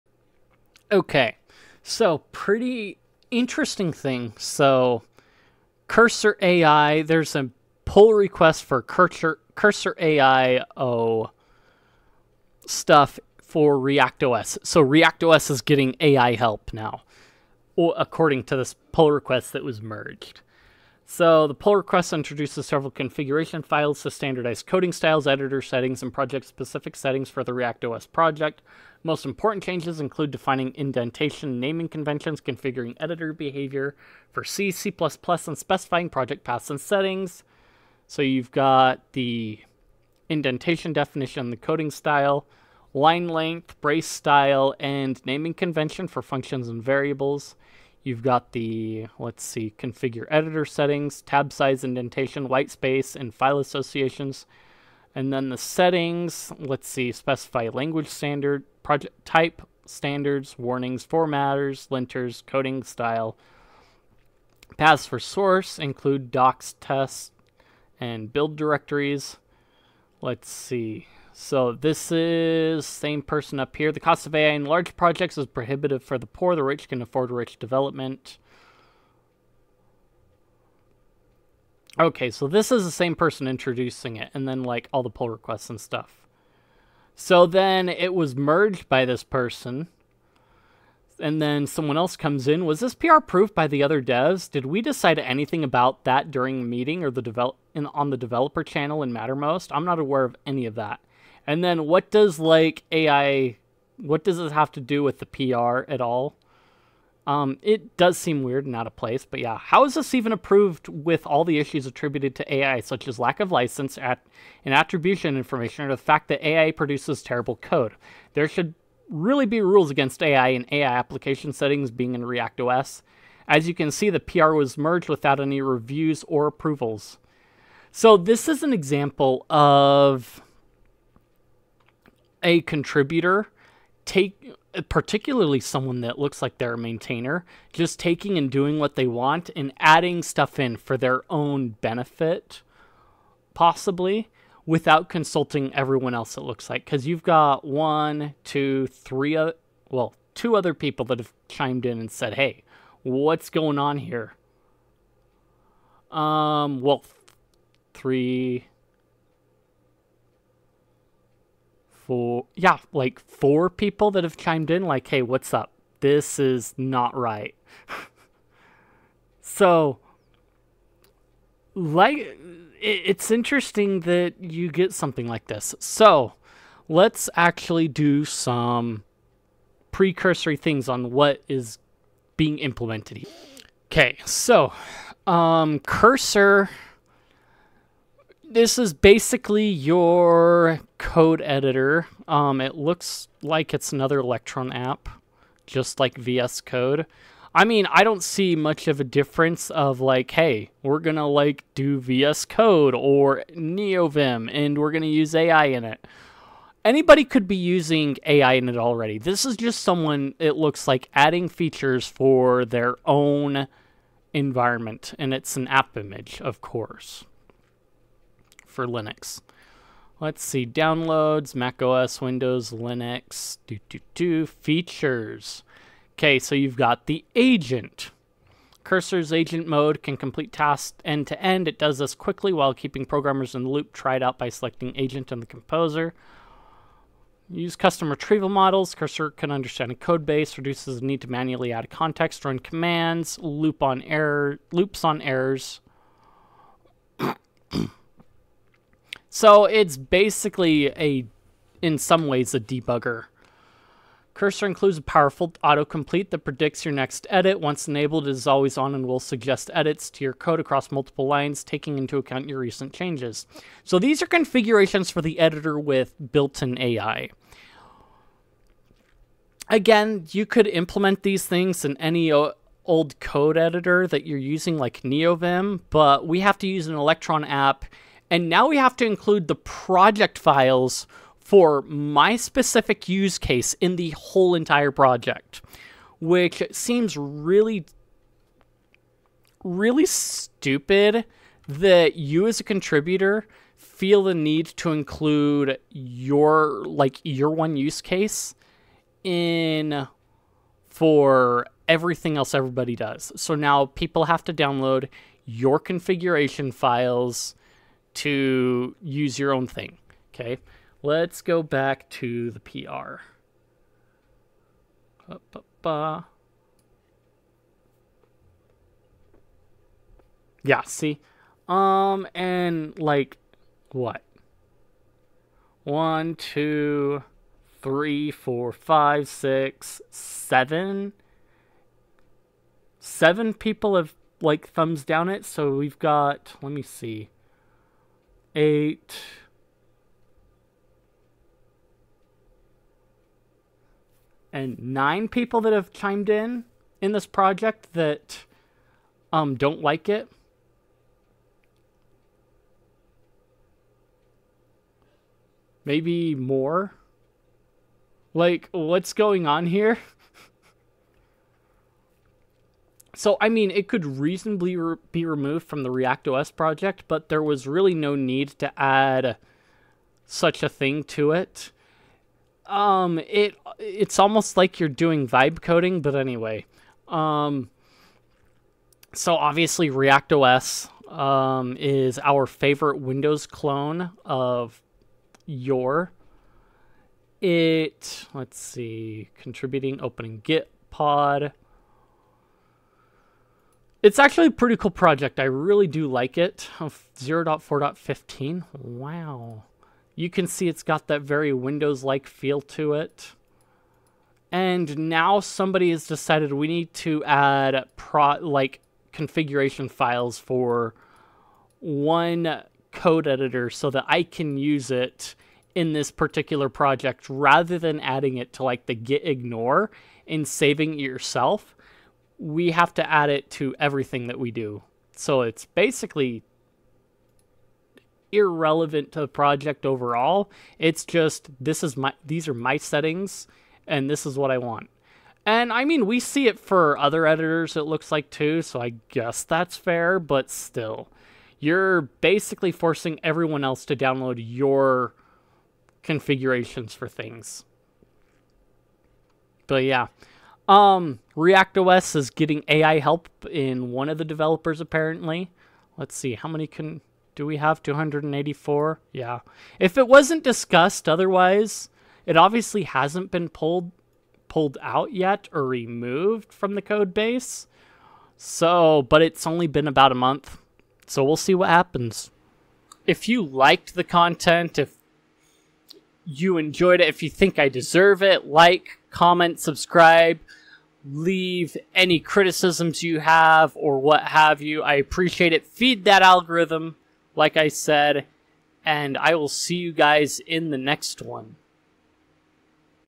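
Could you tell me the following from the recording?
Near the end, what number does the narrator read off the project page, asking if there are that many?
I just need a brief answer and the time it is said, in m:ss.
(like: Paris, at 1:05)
284, at 7:37.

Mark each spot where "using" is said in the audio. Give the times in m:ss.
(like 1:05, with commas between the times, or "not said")
3:27, 4:34.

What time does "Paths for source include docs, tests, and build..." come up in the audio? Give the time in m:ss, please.
1:04.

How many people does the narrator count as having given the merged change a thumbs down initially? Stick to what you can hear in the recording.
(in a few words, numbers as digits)
7.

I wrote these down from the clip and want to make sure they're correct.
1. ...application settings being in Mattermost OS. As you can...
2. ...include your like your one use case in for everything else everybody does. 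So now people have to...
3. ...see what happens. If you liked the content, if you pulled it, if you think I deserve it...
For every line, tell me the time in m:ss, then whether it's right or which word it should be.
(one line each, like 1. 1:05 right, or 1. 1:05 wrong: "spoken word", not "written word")
1. 2:00 wrong: "React", not "Mattermost"
2. 4:54 right
3. 7:51 wrong: "enjoyed", not "pulled".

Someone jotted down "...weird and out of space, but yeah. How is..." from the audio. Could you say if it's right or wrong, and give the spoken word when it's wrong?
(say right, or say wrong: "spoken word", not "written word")
wrong: "place", not "space".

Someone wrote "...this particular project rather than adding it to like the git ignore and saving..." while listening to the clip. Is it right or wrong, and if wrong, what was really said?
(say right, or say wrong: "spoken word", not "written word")
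right.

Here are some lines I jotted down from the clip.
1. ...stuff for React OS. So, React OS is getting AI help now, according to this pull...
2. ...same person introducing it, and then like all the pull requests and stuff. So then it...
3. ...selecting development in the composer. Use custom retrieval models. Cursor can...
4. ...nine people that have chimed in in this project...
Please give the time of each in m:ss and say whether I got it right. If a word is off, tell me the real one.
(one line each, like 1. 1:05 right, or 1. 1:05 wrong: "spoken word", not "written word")
1. 0:12 right
2. 1:22 right
3. 3:54 wrong: "agent", not "development"
4. 5:44 right.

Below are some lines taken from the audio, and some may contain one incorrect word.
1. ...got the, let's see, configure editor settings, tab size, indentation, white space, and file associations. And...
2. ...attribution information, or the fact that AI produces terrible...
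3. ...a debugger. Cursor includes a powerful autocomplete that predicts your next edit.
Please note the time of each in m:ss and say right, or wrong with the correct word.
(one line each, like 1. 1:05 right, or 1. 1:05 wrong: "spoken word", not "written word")
1. 0:48 right
2. 1:54 right
3. 4:12 right.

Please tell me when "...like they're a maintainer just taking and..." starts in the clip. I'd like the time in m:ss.
2:16.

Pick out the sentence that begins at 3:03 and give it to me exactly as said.
Okay, so um, cursor this is basically your code editor.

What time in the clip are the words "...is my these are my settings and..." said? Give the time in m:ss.
7:11.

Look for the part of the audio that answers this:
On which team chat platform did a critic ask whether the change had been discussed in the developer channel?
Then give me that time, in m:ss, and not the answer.
1:39.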